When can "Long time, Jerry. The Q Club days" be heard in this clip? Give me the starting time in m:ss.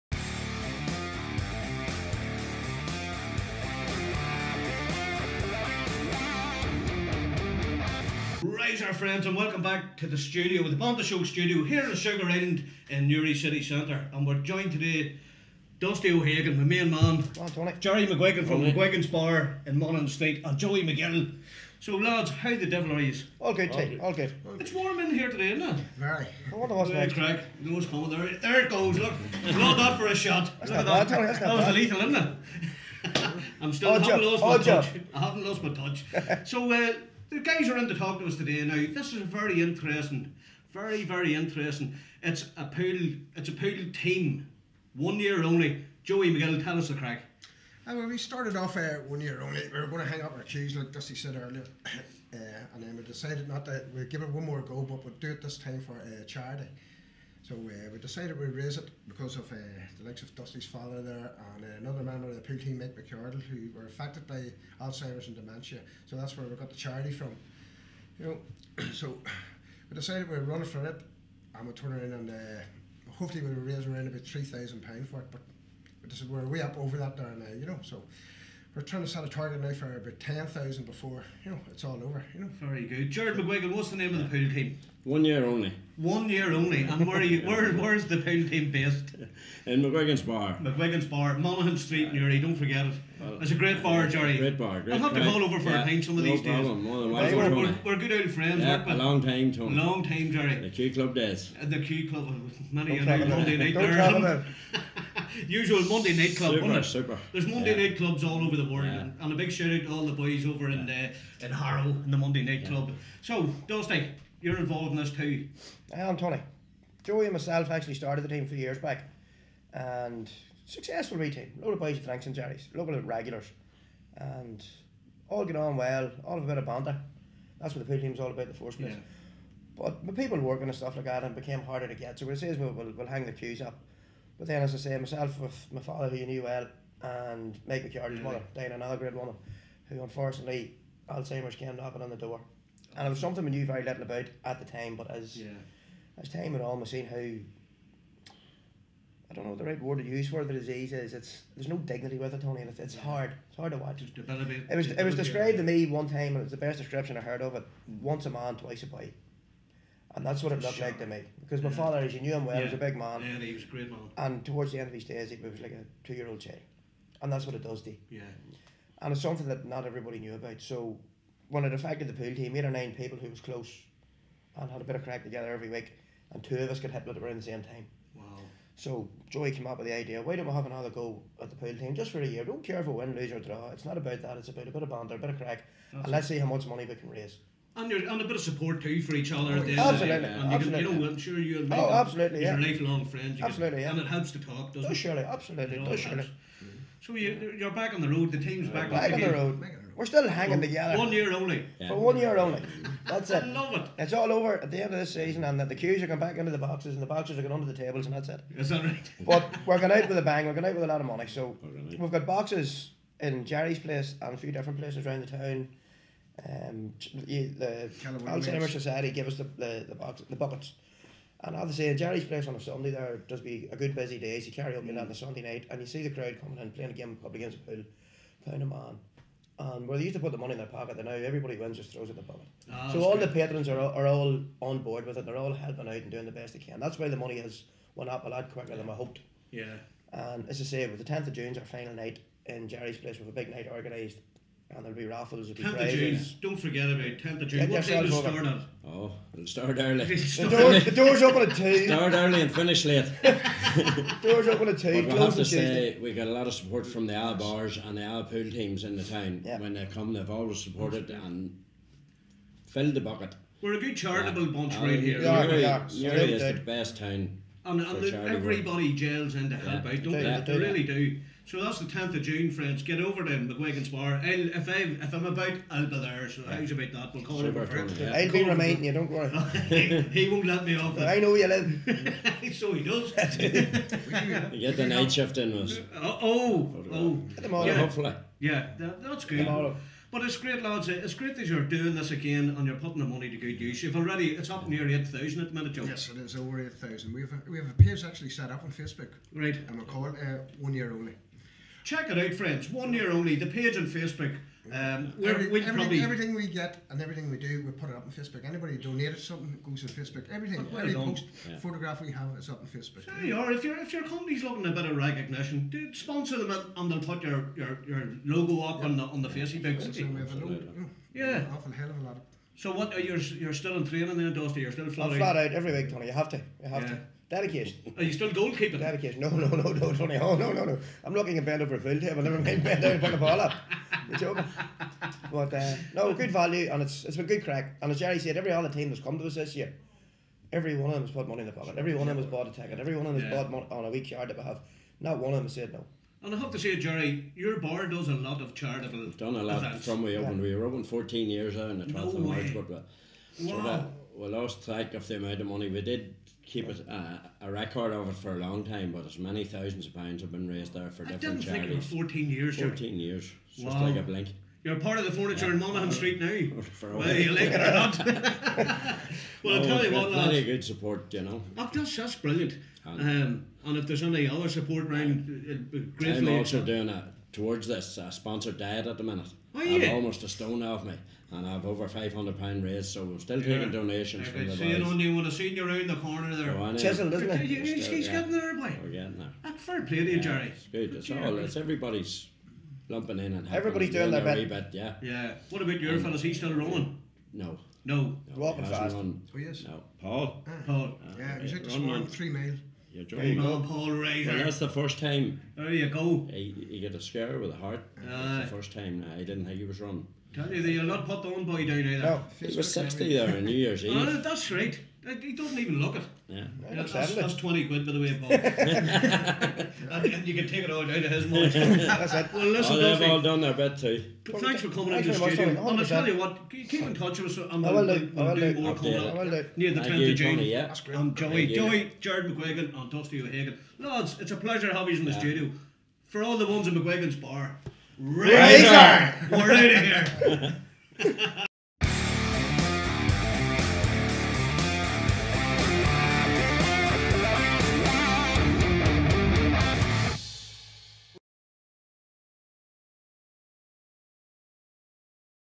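1:39.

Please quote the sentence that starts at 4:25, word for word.
Yeah, Newry- we Newry is the best town.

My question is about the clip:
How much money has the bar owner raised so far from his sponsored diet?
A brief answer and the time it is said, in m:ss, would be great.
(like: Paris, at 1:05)
over £500, at 6:21.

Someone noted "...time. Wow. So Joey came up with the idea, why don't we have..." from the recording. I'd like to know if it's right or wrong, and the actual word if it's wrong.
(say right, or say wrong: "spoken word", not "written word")
right.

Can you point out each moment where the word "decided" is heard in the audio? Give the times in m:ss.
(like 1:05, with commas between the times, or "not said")
0:53, 0:57, 1:09.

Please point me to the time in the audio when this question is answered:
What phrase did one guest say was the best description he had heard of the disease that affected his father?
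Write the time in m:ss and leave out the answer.
2:38.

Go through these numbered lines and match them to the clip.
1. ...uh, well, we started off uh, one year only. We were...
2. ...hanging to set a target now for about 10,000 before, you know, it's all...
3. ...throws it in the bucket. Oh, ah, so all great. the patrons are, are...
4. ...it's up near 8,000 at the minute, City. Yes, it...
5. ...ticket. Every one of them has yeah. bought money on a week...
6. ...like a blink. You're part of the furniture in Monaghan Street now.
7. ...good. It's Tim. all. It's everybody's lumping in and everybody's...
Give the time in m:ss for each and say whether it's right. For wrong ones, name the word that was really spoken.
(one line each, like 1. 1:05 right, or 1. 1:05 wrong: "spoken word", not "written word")
1. 0:47 right
2. 1:18 wrong: "trying", not "hanging"
3. 3:51 right
4. 4:54 wrong: "Joe", not "City"
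5. 5:42 right
6. 6:03 right
7. 6:30 wrong: "Jerry", not "Tim".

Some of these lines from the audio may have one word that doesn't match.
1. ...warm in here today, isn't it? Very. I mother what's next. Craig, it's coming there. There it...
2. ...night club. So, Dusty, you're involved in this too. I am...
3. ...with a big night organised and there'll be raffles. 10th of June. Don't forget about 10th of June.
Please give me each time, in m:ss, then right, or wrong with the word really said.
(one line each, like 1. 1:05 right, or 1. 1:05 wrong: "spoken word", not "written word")
1. 0:24 wrong: "wonder", not "mother"
2. 1:52 right
3. 4:03 right.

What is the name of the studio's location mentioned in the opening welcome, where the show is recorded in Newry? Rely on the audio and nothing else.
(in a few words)
Sugar Island.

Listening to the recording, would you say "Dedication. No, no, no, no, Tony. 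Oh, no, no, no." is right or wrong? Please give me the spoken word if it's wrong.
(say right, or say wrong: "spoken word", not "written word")
right.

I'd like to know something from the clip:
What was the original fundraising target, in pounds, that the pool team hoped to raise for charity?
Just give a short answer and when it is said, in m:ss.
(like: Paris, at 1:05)
£3,000, at 1:14.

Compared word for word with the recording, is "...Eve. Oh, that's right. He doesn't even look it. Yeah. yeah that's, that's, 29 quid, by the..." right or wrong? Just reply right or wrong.
wrong.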